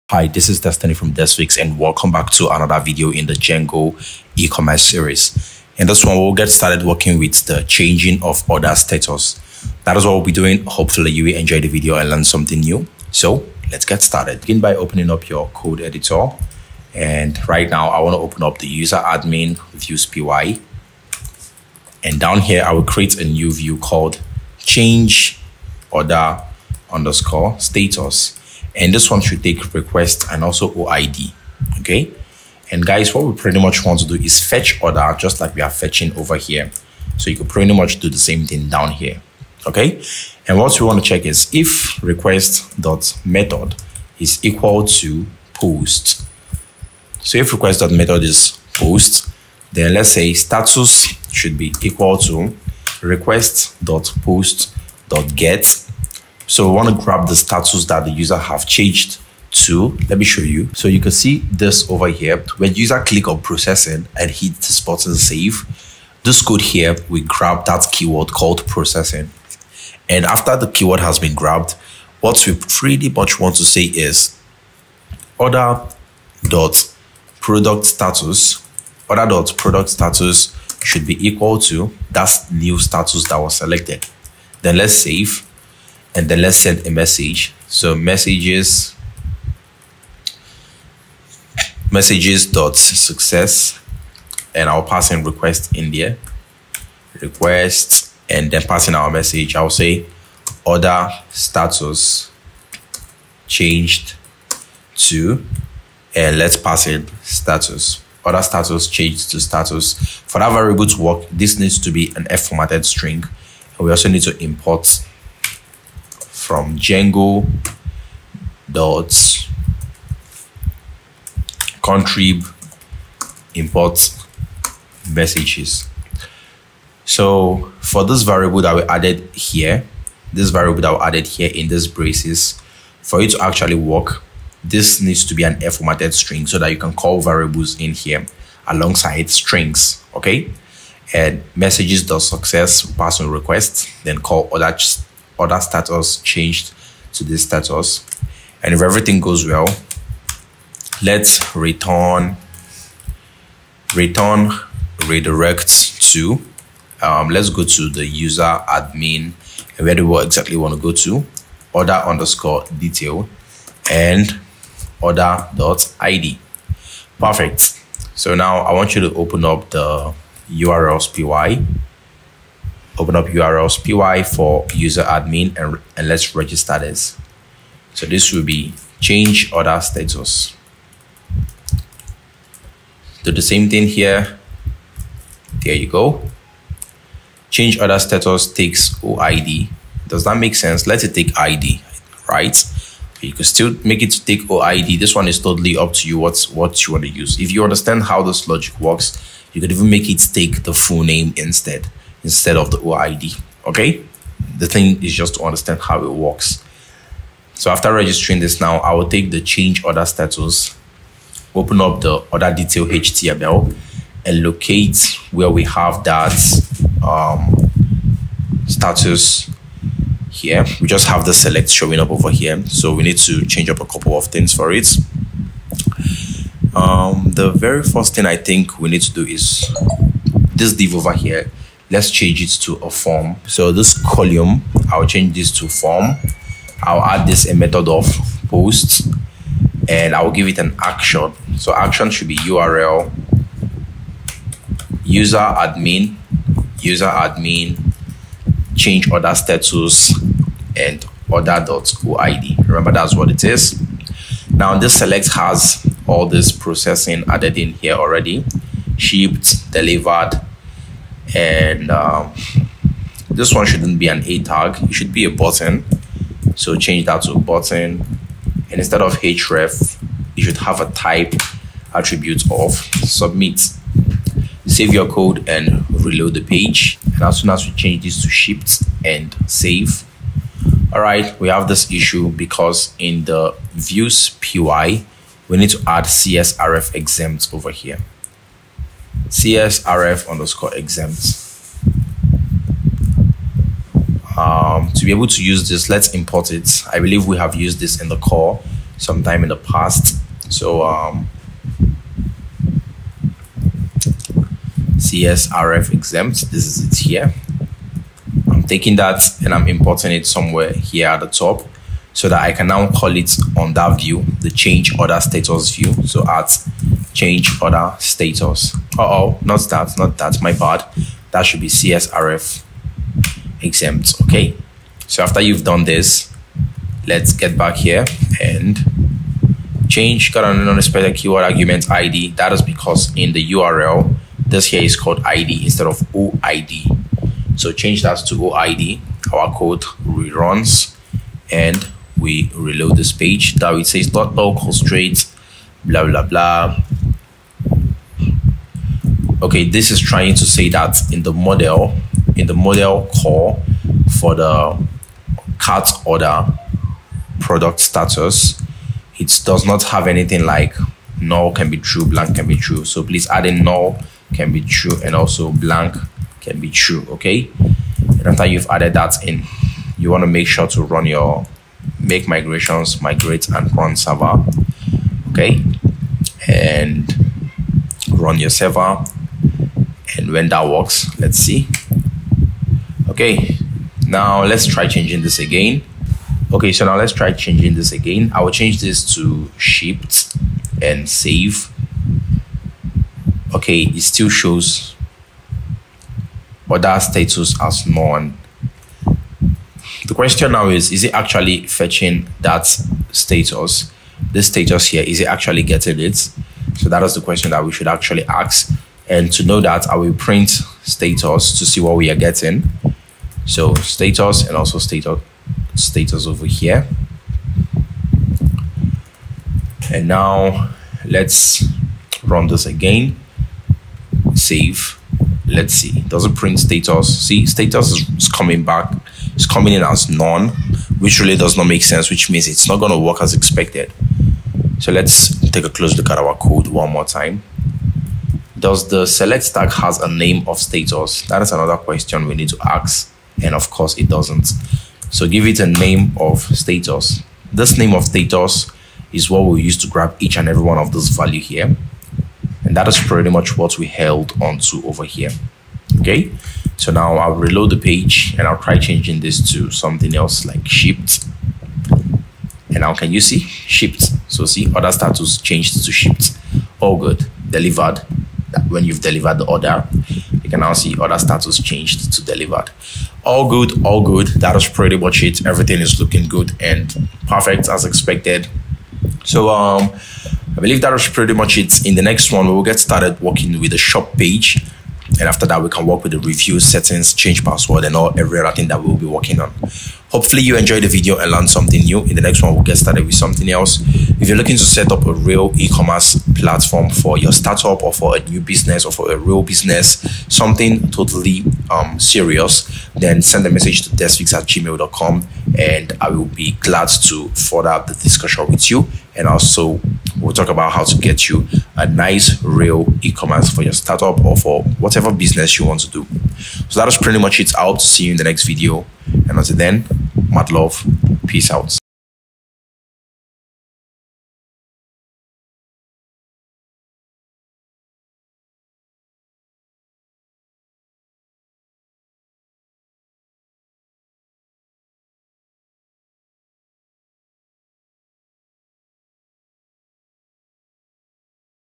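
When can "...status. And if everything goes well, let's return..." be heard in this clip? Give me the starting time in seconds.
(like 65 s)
147 s.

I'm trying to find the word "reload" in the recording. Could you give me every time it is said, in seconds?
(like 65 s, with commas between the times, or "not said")
276 s, 342 s, 457 s.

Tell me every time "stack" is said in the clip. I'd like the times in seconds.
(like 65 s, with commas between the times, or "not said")
439 s.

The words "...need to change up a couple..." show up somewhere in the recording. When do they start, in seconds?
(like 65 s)
223 s.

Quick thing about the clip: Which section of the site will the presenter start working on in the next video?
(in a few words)
shop page.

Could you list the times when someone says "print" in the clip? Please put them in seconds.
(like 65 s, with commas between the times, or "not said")
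410 s, 426 s.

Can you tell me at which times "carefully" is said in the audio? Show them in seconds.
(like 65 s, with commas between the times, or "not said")
not said.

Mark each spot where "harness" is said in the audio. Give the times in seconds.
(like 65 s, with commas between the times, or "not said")
not said.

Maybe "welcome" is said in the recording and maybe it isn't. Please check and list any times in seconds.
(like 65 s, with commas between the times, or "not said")
1 s.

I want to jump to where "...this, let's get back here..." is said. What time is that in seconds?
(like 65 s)
325 s.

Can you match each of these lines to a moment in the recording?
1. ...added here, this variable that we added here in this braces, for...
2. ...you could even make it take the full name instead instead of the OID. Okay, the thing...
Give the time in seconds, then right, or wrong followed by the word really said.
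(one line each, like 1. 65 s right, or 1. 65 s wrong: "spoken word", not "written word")
1. 128 s right
2. 199 s right.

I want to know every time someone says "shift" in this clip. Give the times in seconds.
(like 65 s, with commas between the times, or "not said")
278 s, 389 s.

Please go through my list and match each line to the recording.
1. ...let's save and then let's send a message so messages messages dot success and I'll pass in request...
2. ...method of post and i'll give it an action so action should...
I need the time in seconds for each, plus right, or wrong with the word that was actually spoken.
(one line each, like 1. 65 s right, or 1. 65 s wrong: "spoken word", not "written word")
1. 84 s right
2. 237 s right.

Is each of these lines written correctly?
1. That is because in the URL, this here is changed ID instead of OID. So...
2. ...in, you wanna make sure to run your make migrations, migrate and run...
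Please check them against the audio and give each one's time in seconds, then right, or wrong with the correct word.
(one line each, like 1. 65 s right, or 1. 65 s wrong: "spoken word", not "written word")
1. 332 s wrong: "called", not "changed"
2. 369 s right.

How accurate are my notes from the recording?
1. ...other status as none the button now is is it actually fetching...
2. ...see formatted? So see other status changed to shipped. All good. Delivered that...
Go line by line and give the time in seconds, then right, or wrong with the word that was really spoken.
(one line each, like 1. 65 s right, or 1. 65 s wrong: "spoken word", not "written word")
1. 396 s wrong: "question", not "button"
2. 463 s wrong: "shipped", not "formatted".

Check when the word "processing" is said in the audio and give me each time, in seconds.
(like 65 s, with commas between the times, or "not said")
63 s, 68 s, 256 s.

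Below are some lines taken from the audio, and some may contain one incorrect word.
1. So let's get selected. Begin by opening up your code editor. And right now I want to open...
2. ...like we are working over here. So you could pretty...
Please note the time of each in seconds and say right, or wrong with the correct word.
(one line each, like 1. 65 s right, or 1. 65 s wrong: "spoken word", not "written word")
1. 13 s wrong: "started", not "selected"
2. 35 s wrong: "fetching", not "working".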